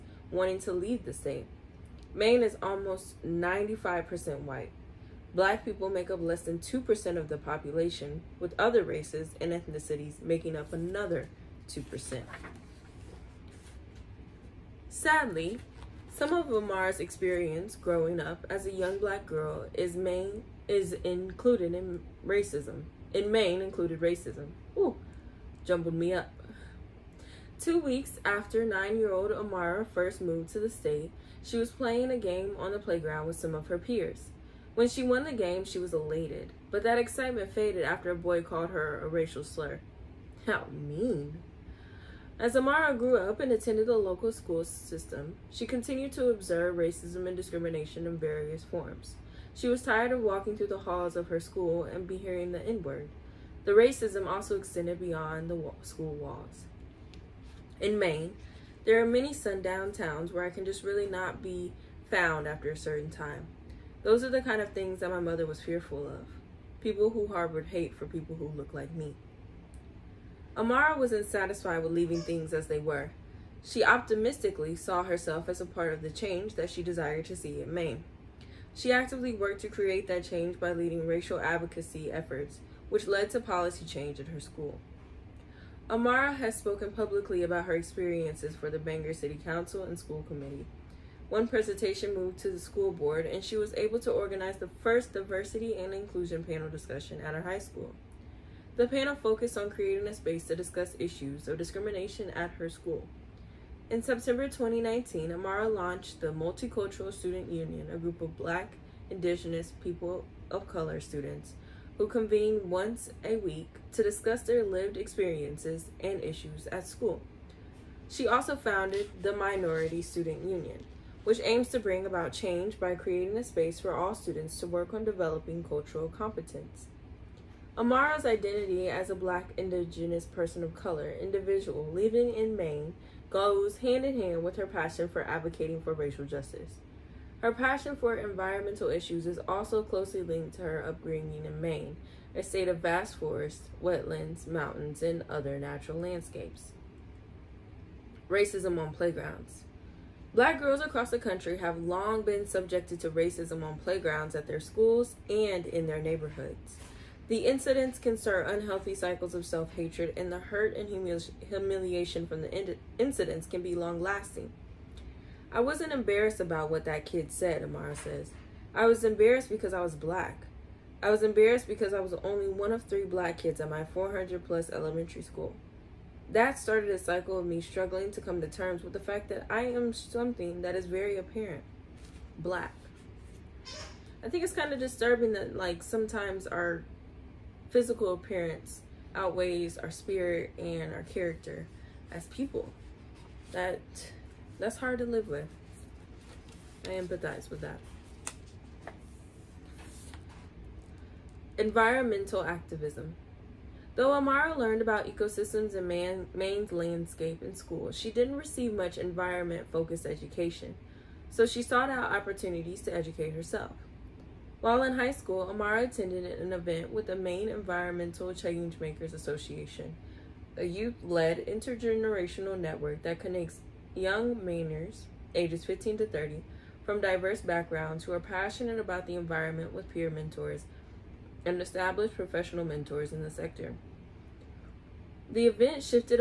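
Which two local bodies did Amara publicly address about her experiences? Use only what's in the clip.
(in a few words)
Bangor City Council and School Committee.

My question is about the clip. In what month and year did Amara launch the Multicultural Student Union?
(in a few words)
September 2019.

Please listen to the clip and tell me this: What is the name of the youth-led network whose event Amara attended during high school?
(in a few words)
Maine Environmental Changemakers Association.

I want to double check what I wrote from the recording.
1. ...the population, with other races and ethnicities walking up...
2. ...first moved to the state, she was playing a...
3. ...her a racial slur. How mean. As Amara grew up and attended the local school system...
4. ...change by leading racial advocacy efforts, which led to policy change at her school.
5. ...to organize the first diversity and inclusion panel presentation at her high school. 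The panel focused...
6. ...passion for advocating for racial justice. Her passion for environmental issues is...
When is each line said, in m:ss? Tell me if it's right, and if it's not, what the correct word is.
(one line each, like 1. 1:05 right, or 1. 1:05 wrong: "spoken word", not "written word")
1. 0:07 wrong: "making", not "walking"
2. 0:29 right
3. 0:38 right
4. 1:20 right
5. 1:34 wrong: "discussion", not "presentation"
6. 2:14 right.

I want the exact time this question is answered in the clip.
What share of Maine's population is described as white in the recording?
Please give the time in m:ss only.
0:02.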